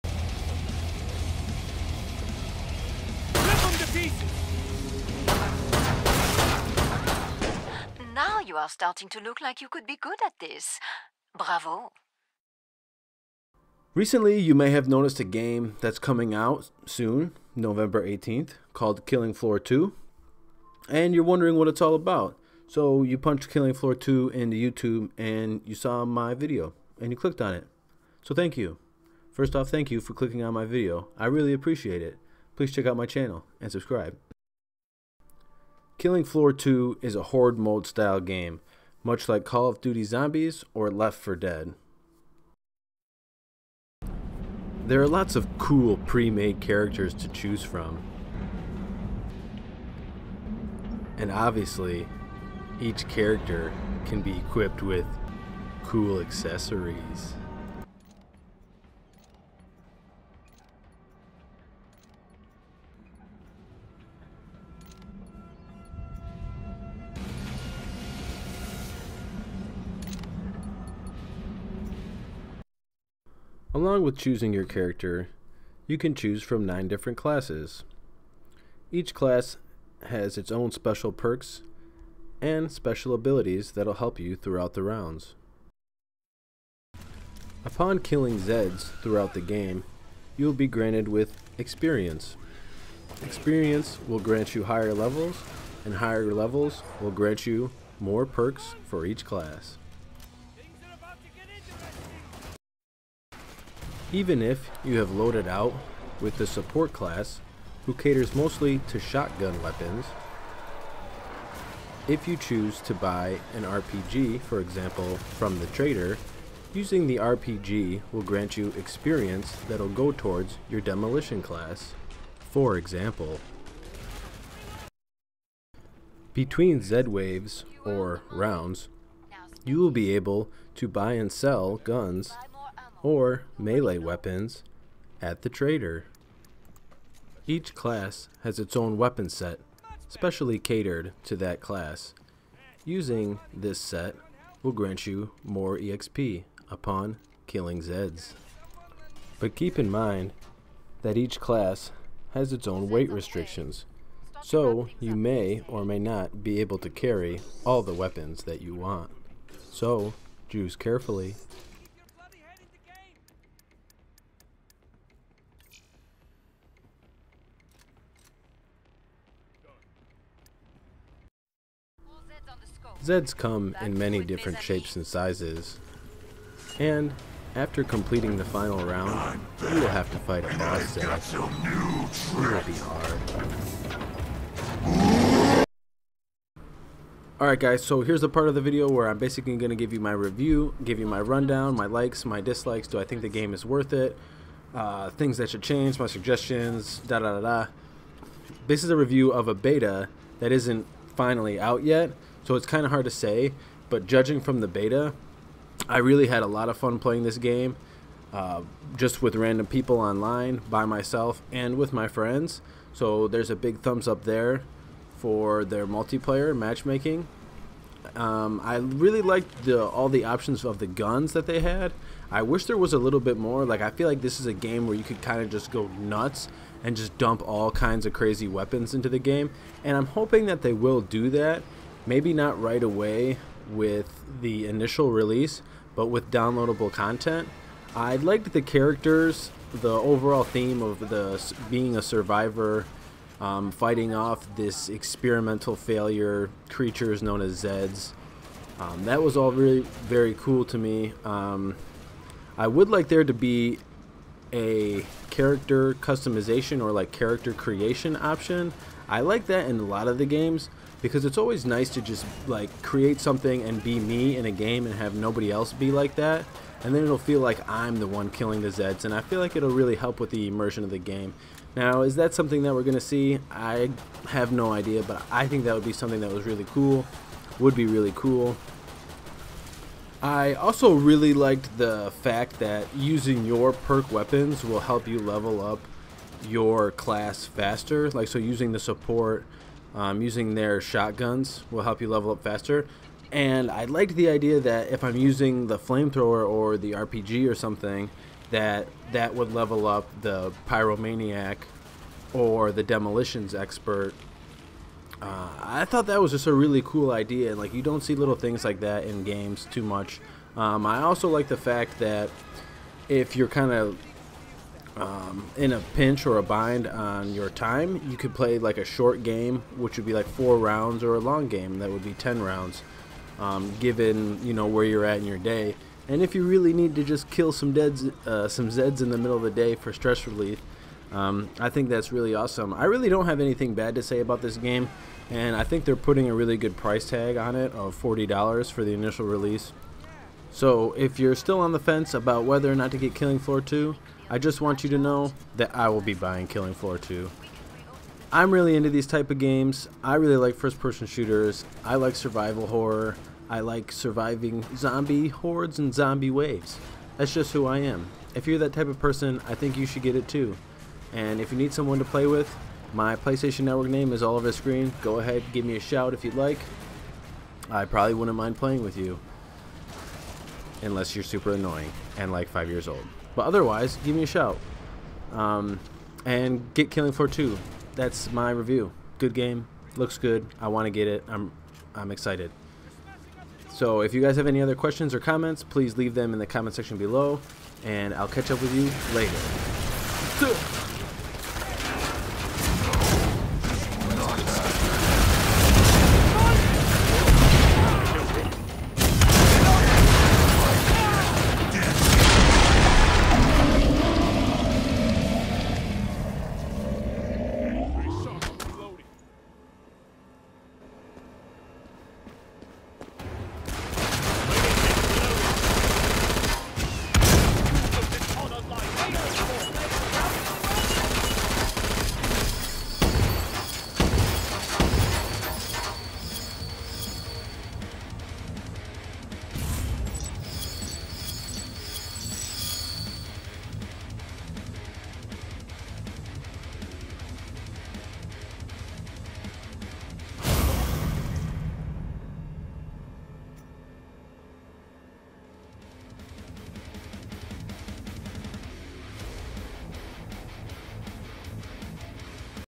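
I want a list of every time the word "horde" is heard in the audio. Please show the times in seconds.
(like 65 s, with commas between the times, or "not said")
37 s, 355 s.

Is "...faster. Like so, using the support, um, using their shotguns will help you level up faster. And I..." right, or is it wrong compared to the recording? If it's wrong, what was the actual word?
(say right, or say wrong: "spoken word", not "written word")
right.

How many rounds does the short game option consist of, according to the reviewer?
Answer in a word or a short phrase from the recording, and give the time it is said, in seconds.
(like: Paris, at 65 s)
4, at 320 s.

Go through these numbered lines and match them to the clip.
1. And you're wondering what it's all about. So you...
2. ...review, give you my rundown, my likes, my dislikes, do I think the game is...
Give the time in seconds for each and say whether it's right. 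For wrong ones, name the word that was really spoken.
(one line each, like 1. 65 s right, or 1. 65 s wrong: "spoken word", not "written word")
1. 20 s right
2. 190 s right.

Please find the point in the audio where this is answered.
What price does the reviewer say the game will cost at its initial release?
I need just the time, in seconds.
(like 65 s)
337 s.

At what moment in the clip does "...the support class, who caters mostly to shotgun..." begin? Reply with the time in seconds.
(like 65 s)
106 s.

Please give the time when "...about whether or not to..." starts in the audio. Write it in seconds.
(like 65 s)
342 s.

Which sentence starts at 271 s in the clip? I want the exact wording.
Now is that something that we're gonna see?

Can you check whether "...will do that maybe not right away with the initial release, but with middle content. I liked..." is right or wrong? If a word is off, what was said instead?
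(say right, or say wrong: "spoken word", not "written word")
wrong: "downloadable", not "middle".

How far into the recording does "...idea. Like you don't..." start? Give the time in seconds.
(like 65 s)
307 s.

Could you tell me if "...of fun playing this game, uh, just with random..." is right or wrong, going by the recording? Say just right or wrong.
right.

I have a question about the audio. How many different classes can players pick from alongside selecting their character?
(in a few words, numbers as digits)
9.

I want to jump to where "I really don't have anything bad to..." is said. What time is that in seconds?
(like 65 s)
332 s.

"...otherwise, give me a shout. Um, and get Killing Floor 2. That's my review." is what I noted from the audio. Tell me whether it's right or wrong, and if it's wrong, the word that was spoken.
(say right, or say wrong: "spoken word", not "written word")
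right.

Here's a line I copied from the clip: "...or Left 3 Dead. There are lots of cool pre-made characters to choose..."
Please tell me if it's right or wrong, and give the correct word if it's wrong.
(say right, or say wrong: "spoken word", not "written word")
wrong: "4", not "3".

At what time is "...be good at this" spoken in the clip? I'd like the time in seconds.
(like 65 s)
9 s.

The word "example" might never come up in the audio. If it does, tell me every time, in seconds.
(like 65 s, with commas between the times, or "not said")
114 s, 122 s.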